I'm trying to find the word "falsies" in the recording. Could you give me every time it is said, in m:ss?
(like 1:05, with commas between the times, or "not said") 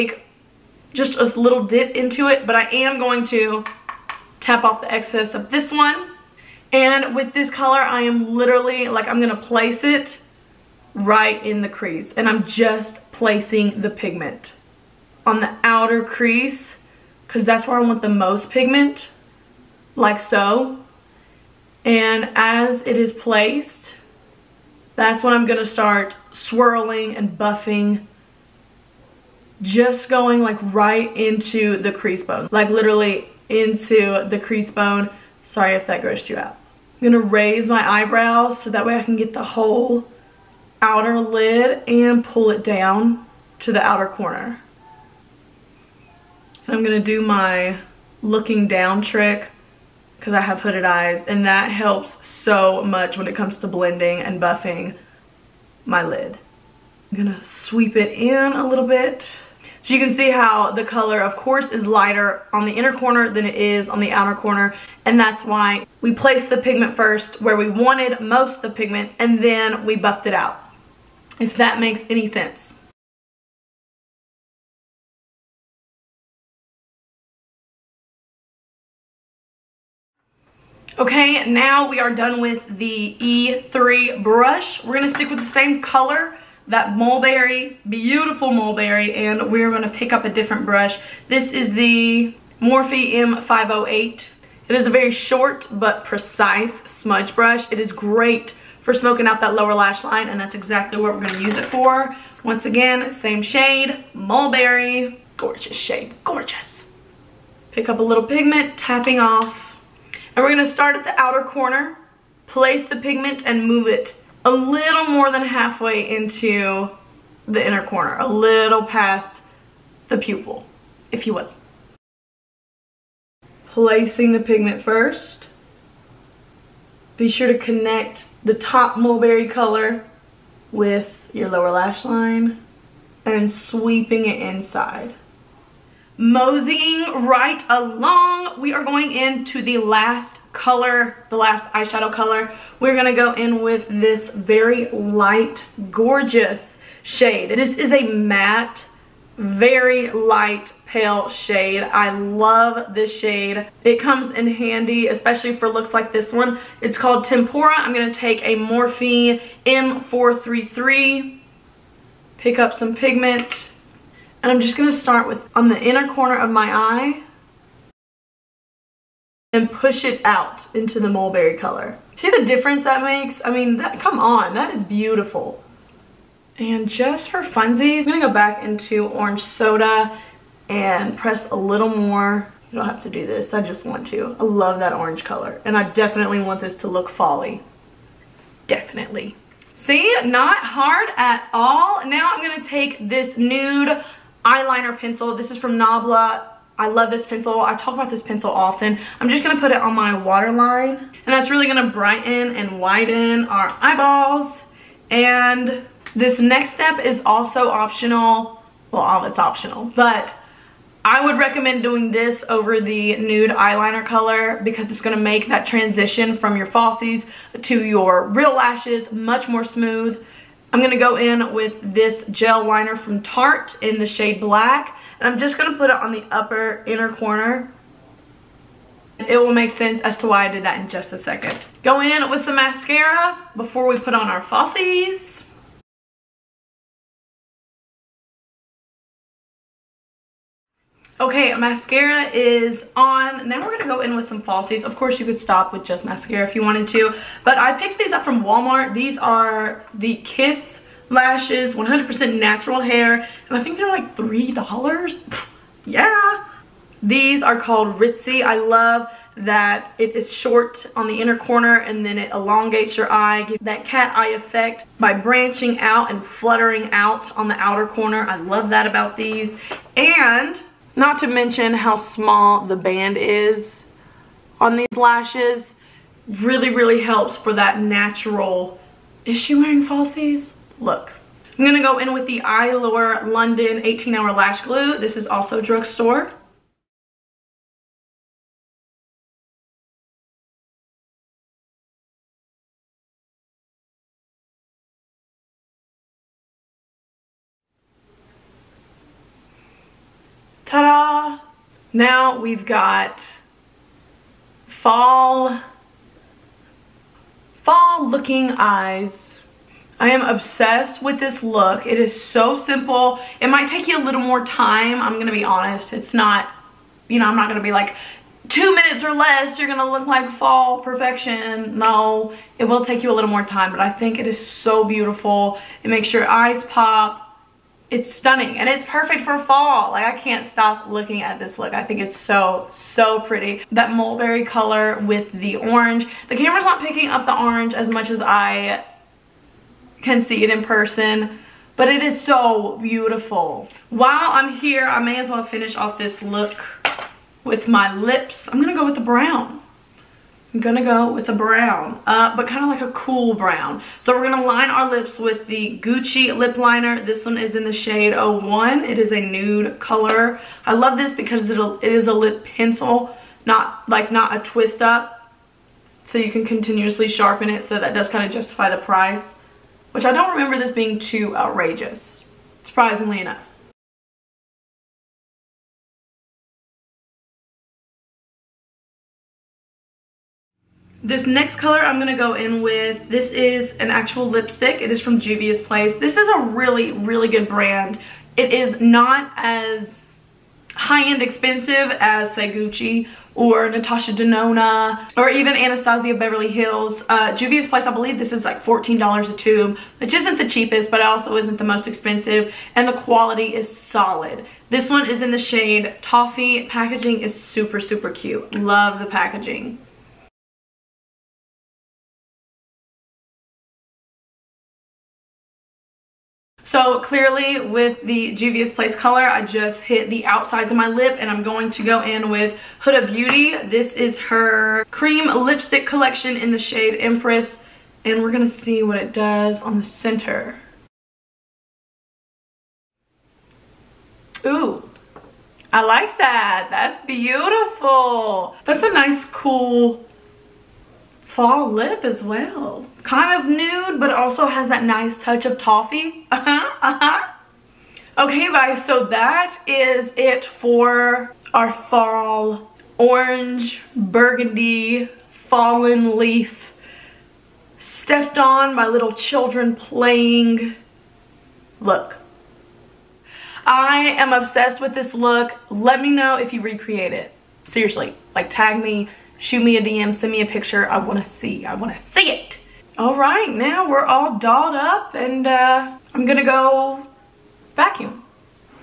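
3:36, 3:54, 4:04, 4:39.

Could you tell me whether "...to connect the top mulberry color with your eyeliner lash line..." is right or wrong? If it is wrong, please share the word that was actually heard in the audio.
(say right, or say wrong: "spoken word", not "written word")
wrong: "lower", not "eyeliner".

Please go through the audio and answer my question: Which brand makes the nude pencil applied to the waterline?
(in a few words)
Nabla.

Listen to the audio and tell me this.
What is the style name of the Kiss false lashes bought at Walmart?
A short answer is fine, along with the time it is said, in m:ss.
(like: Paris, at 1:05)
Ritzy, at 4:17.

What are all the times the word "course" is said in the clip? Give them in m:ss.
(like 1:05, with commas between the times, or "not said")
1:01, 4:04.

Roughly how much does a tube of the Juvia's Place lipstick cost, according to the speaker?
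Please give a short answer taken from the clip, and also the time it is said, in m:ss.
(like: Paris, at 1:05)
$14, at 6:38.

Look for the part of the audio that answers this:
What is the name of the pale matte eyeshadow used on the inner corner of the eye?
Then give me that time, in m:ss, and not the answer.
2:37.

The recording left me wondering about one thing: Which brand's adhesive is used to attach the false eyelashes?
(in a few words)
Eylure London.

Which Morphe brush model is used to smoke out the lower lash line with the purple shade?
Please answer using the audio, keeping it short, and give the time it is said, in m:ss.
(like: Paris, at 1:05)
M508, at 1:32.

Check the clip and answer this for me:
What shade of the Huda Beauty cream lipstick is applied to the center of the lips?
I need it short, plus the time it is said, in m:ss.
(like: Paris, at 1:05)
Empress, at 7:06.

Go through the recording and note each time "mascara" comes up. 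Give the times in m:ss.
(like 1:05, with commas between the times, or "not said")
3:52, 4:01, 4:06.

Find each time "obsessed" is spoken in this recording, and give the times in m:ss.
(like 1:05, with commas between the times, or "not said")
5:10, 7:44.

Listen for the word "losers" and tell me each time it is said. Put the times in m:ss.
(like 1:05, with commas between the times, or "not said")
not said.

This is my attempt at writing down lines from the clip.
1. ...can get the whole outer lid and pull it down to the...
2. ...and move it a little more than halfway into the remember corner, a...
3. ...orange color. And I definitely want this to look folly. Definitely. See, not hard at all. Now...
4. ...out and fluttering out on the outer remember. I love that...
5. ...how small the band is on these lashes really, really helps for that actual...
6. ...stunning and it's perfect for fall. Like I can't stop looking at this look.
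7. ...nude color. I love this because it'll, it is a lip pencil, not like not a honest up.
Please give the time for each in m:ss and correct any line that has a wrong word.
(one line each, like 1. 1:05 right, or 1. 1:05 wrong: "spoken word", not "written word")
1. 0:39 right
2. 1:53 wrong: "inner", not "remember"
3. 3:04 right
4. 4:25 wrong: "corner", not "remember"
5. 4:31 wrong: "natural", not "actual"
6. 5:28 right
7. 5:59 wrong: "twist", not "honest".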